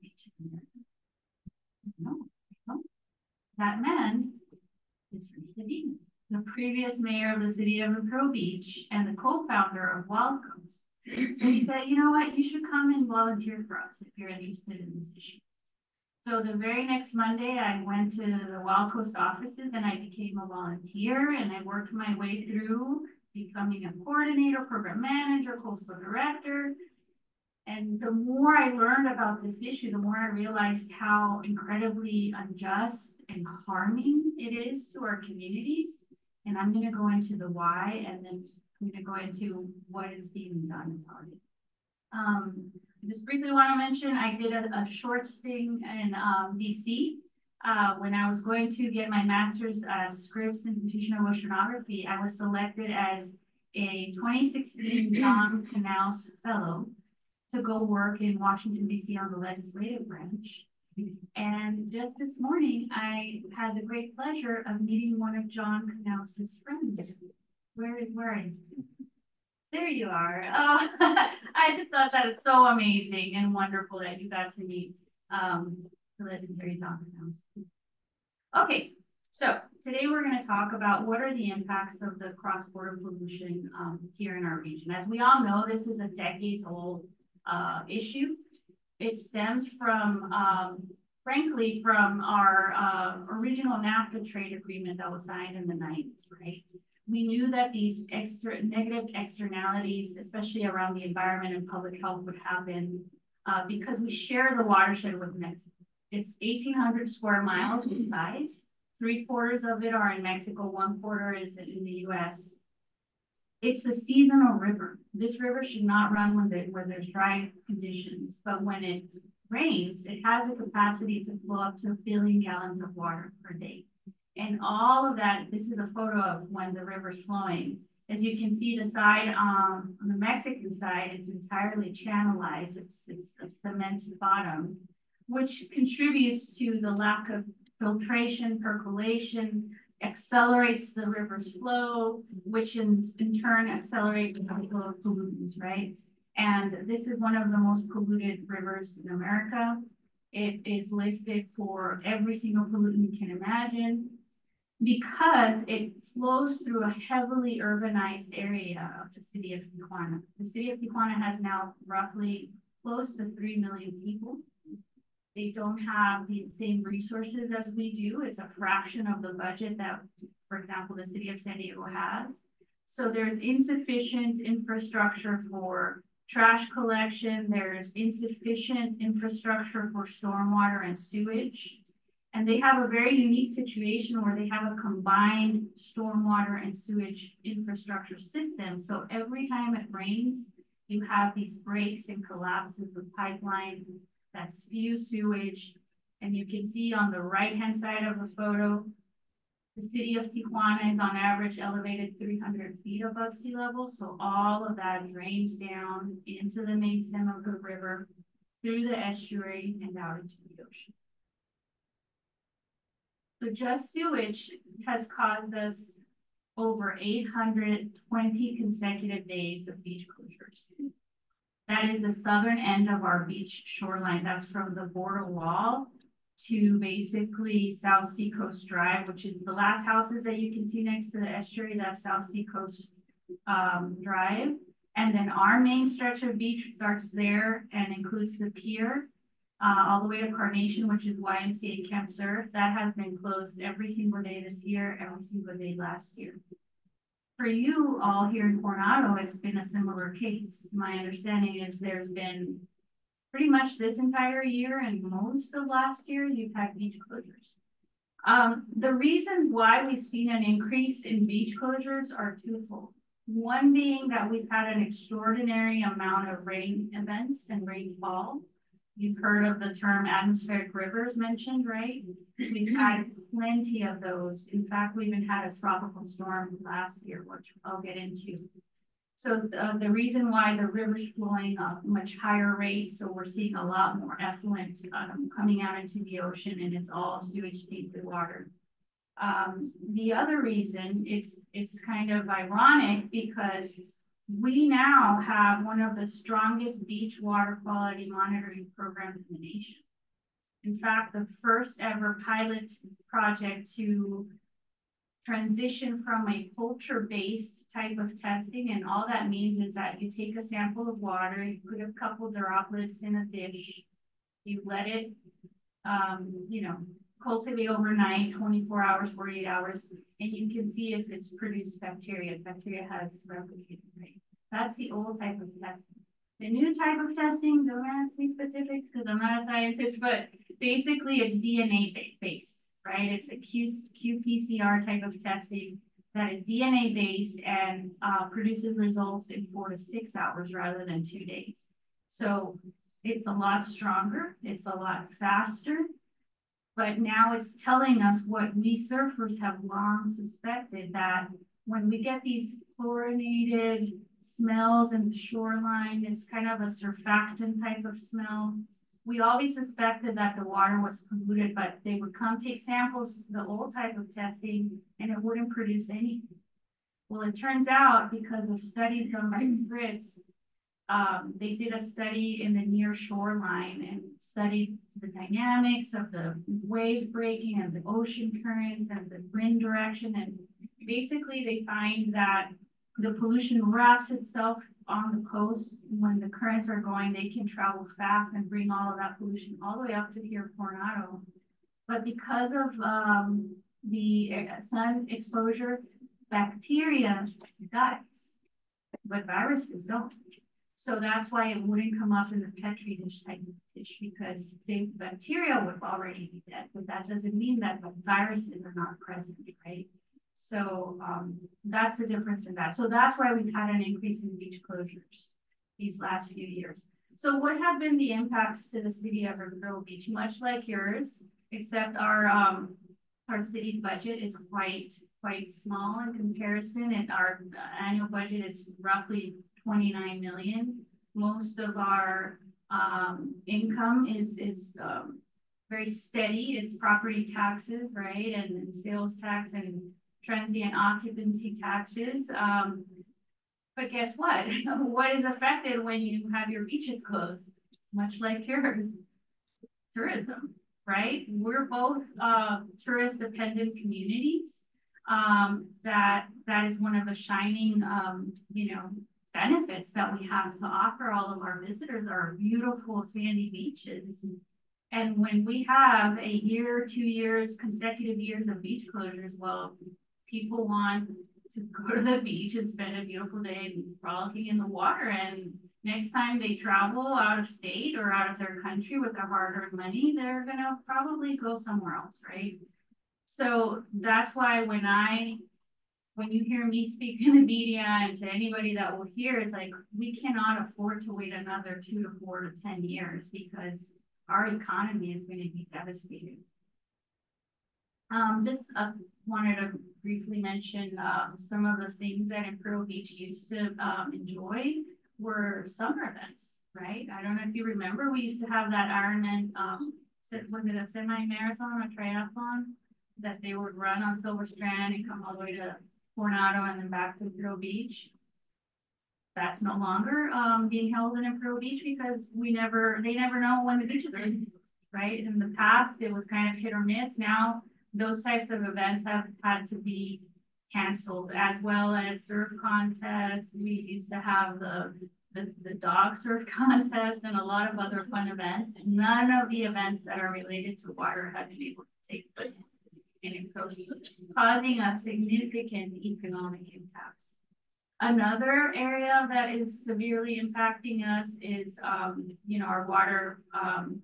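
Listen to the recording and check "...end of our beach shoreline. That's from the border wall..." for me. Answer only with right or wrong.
right.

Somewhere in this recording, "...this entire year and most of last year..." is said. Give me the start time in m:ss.
4:13.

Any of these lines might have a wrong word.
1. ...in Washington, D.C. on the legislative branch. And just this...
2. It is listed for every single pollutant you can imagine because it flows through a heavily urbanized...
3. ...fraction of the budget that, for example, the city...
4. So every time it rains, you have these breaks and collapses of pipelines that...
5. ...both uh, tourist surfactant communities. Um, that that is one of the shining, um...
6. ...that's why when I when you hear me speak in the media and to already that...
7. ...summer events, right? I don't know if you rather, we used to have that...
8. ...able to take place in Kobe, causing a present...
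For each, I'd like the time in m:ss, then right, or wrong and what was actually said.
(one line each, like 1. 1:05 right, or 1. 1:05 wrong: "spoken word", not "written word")
1. 0:58 right
2. 2:30 right
3. 2:48 right
4. 3:08 right
5. 7:31 wrong: "dependent", not "surfactant"
6. 8:03 wrong: "anybody", not "already"
7. 8:25 wrong: "remember", not "rather"
8. 9:01 wrong: "significant", not "present".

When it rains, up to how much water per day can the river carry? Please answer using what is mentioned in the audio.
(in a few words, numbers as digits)
a billion gallons.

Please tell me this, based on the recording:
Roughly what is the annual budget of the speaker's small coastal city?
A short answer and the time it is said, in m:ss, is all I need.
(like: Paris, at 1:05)
29 million, at 7:09.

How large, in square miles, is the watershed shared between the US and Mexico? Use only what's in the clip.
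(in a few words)
1,800 square miles.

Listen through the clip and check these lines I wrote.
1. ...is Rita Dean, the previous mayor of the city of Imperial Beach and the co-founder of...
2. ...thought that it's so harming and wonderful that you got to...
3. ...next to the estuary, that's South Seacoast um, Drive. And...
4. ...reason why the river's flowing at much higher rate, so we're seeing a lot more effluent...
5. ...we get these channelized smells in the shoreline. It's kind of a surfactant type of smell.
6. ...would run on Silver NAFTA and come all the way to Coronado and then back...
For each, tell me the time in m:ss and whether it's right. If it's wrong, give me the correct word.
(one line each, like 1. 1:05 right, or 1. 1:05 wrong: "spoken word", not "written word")
1. 0:05 right
2. 1:11 wrong: "amazing", not "harming"
3. 3:50 right
4. 4:39 right
5. 5:51 wrong: "chlorinated", not "channelized"
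6. 8:33 wrong: "Strand", not "NAFTA".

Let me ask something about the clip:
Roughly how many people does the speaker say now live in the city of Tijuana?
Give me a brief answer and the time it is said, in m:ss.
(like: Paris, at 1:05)
close to 3 million, at 2:42.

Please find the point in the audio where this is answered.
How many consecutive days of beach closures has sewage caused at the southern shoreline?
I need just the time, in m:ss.
3:36.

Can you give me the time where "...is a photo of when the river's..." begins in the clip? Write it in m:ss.
2:05.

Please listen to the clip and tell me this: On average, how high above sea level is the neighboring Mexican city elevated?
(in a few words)
300 feet.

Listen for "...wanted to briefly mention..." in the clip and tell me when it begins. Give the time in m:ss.
8:19.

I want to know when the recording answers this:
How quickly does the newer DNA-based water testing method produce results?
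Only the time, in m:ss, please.
5:39.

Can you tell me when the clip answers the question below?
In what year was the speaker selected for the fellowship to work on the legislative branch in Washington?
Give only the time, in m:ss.
0:54.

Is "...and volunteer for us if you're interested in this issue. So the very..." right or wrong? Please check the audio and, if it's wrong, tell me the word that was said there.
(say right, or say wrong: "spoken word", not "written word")
right.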